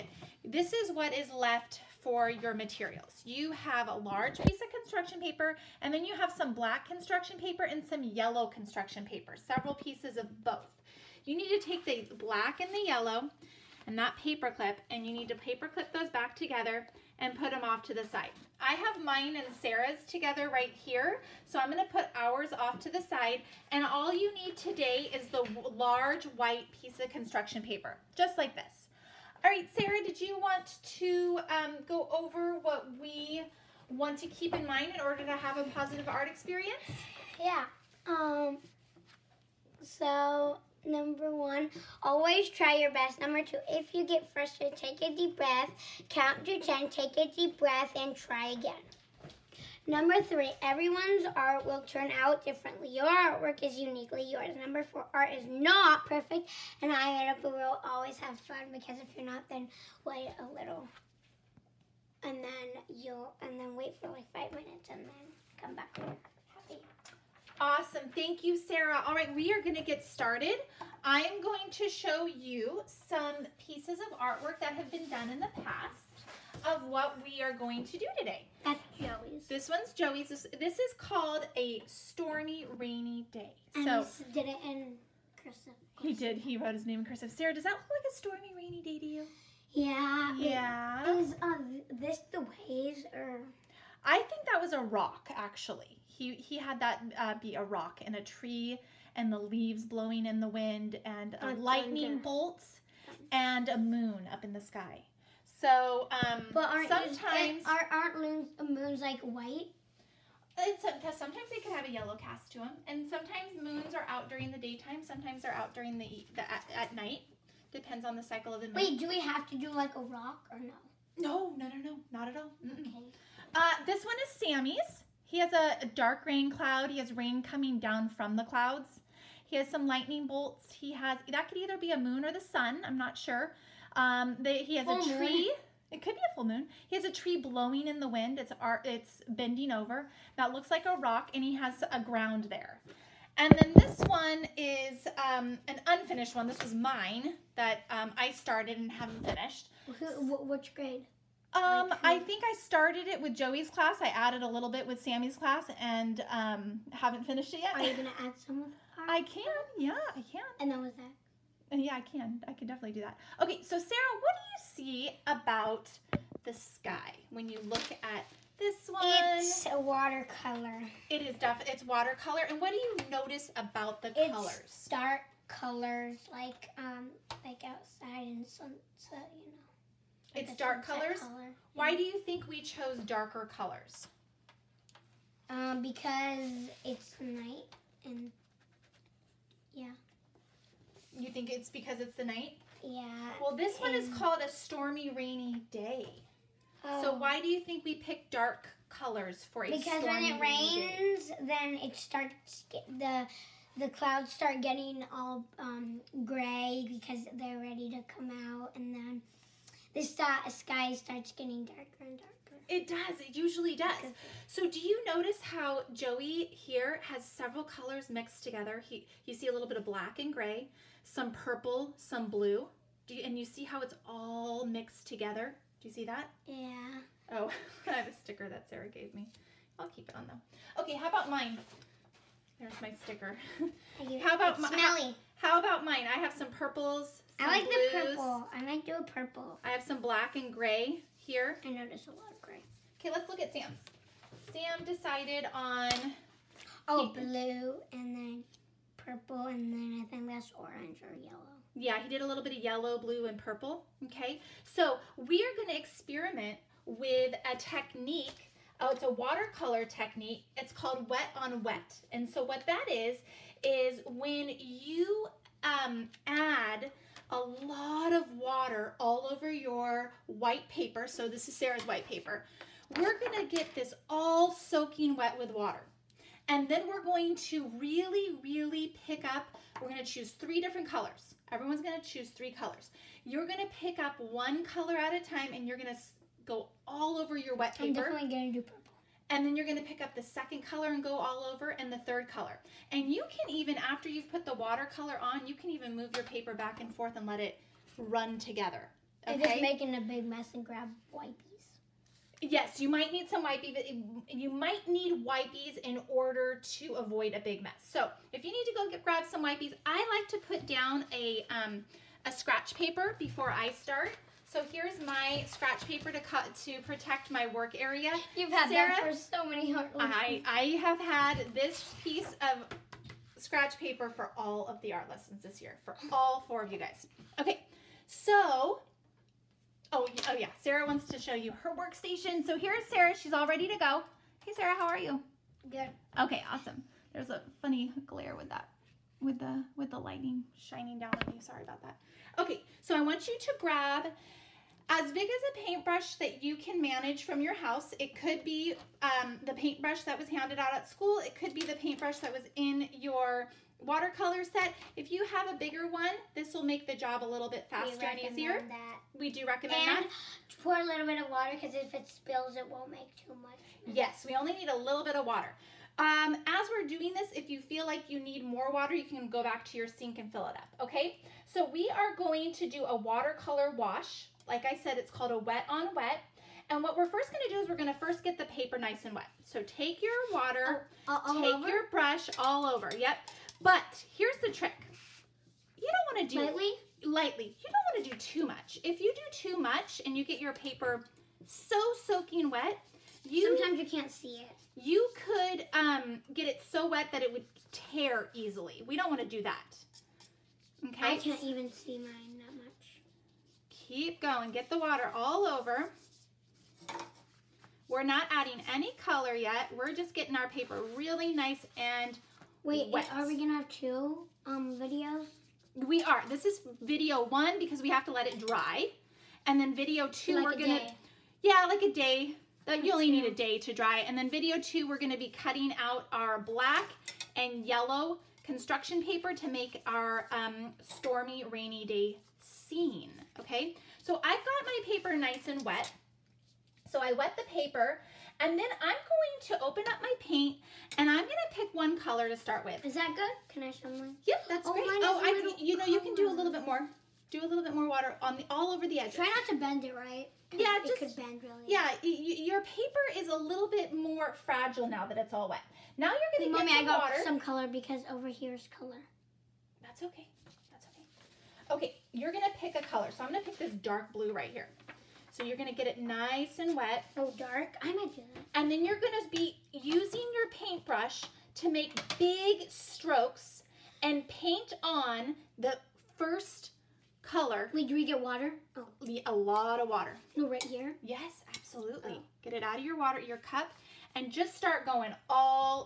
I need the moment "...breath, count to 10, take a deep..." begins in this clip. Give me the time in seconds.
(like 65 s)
45 s.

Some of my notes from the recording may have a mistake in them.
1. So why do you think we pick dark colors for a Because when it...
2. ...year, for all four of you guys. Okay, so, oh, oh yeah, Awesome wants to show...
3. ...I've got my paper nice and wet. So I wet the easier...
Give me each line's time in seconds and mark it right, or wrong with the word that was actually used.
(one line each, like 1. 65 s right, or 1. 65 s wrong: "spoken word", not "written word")
1. 197 s right
2. 325 s wrong: "Sarah", not "Awesome"
3. 434 s wrong: "paper", not "easier".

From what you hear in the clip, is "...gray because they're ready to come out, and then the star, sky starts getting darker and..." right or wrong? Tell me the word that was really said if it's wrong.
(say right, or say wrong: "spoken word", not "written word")
right.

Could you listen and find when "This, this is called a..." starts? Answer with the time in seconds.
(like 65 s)
80 s.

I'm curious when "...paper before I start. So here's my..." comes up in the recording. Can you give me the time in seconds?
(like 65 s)
312 s.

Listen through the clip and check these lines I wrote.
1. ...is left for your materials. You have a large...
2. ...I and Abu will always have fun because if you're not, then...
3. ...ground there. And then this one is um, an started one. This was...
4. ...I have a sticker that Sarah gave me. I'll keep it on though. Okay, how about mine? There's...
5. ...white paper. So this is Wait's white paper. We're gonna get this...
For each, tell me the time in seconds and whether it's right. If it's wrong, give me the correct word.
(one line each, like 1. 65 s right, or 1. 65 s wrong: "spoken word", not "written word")
1. 1 s right
2. 56 s right
3. 142 s wrong: "unfinished", not "started"
4. 227 s right
5. 270 s wrong: "Sarah", not "Wait".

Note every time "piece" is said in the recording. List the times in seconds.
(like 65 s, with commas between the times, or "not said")
4 s, 9 s, 26 s, 73 s, 322 s.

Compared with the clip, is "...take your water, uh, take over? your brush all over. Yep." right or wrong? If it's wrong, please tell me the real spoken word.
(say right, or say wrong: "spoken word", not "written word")
right.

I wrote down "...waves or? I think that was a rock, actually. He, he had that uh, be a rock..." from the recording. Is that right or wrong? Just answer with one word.
right.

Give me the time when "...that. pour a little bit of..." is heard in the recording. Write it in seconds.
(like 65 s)
360 s.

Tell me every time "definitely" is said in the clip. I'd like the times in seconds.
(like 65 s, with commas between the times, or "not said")
162 s, 171 s, 288 s.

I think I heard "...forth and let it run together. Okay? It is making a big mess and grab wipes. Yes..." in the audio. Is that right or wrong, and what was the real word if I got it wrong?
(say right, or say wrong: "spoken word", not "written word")
right.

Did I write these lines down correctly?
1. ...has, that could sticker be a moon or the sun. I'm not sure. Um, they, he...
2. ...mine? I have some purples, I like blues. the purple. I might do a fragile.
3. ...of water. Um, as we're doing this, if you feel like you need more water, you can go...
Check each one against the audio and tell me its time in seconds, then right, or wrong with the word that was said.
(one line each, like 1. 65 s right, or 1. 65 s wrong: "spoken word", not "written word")
1. 130 s wrong: "either", not "sticker"
2. 235 s wrong: "purple", not "fragile"
3. 365 s right.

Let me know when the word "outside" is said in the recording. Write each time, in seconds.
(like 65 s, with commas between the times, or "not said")
177 s.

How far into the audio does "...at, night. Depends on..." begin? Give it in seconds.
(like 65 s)
116 s.